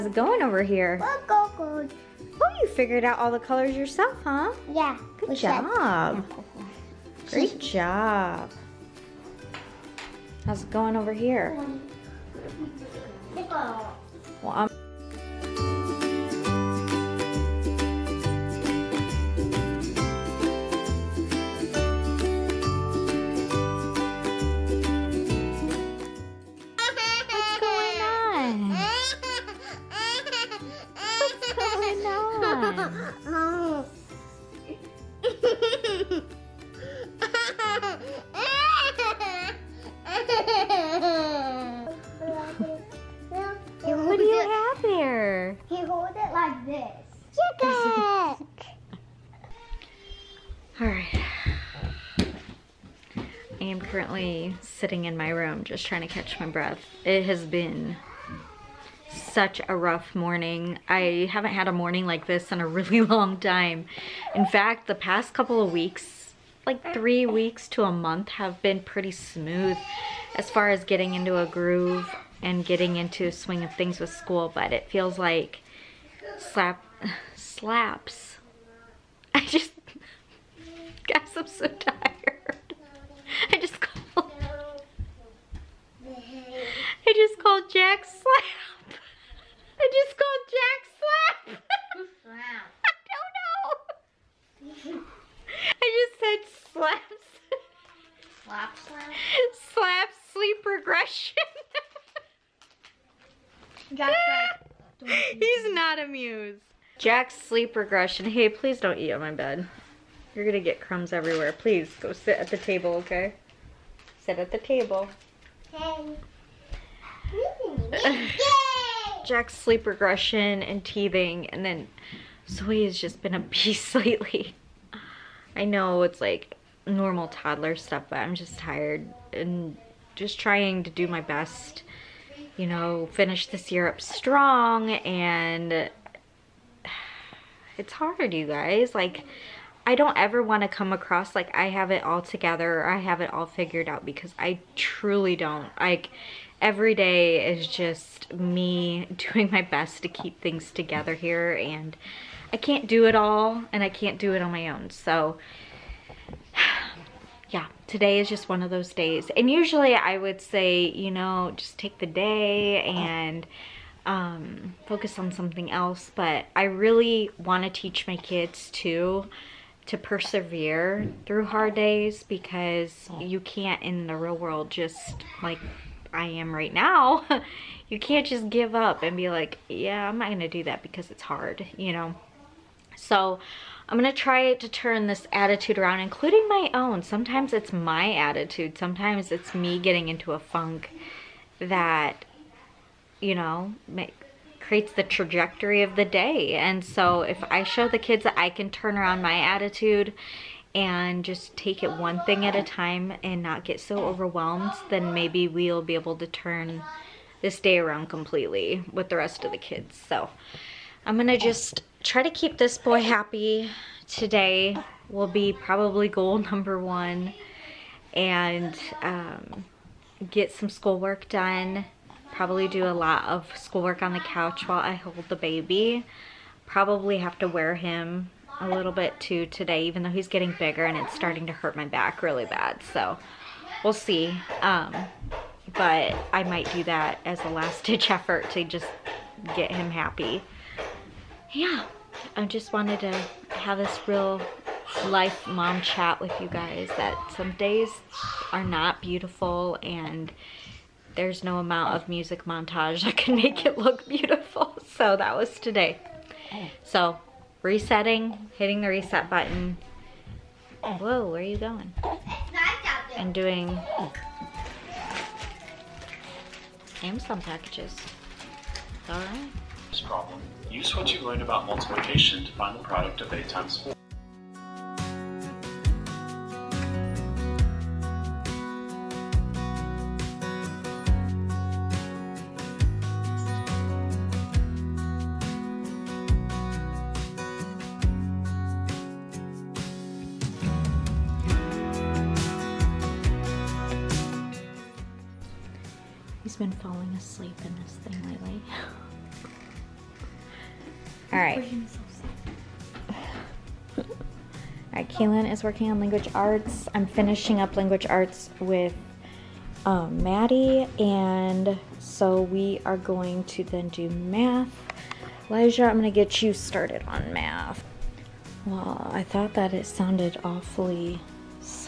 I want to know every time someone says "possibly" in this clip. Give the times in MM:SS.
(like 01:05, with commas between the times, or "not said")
not said.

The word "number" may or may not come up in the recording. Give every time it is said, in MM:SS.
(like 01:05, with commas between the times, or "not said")
03:36.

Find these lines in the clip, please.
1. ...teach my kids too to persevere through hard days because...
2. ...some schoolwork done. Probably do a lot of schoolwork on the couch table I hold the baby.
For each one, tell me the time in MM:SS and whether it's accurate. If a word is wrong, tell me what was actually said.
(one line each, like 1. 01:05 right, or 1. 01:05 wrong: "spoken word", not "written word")
1. 02:47 right
2. 03:40 wrong: "while", not "table".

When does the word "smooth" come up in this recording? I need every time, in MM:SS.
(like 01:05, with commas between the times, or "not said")
01:09.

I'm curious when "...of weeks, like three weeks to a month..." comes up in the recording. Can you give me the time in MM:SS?
01:05.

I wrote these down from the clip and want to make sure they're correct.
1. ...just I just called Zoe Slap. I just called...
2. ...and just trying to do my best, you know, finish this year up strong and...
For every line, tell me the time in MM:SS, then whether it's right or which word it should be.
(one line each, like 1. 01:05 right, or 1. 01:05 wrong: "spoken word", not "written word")
1. 01:23 wrong: "Jack", not "Zoe"
2. 02:09 right.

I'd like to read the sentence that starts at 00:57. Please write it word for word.
It has been such a rough morning.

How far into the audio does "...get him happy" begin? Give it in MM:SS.
03:59.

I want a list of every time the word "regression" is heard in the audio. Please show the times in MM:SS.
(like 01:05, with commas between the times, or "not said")
01:40, 01:47, 01:59.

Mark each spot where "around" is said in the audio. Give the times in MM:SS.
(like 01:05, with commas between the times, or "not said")
03:05, 03:18, 03:27.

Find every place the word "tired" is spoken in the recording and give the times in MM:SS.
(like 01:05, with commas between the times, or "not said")
01:21, 02:08.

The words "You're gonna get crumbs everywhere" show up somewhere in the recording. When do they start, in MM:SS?
01:50.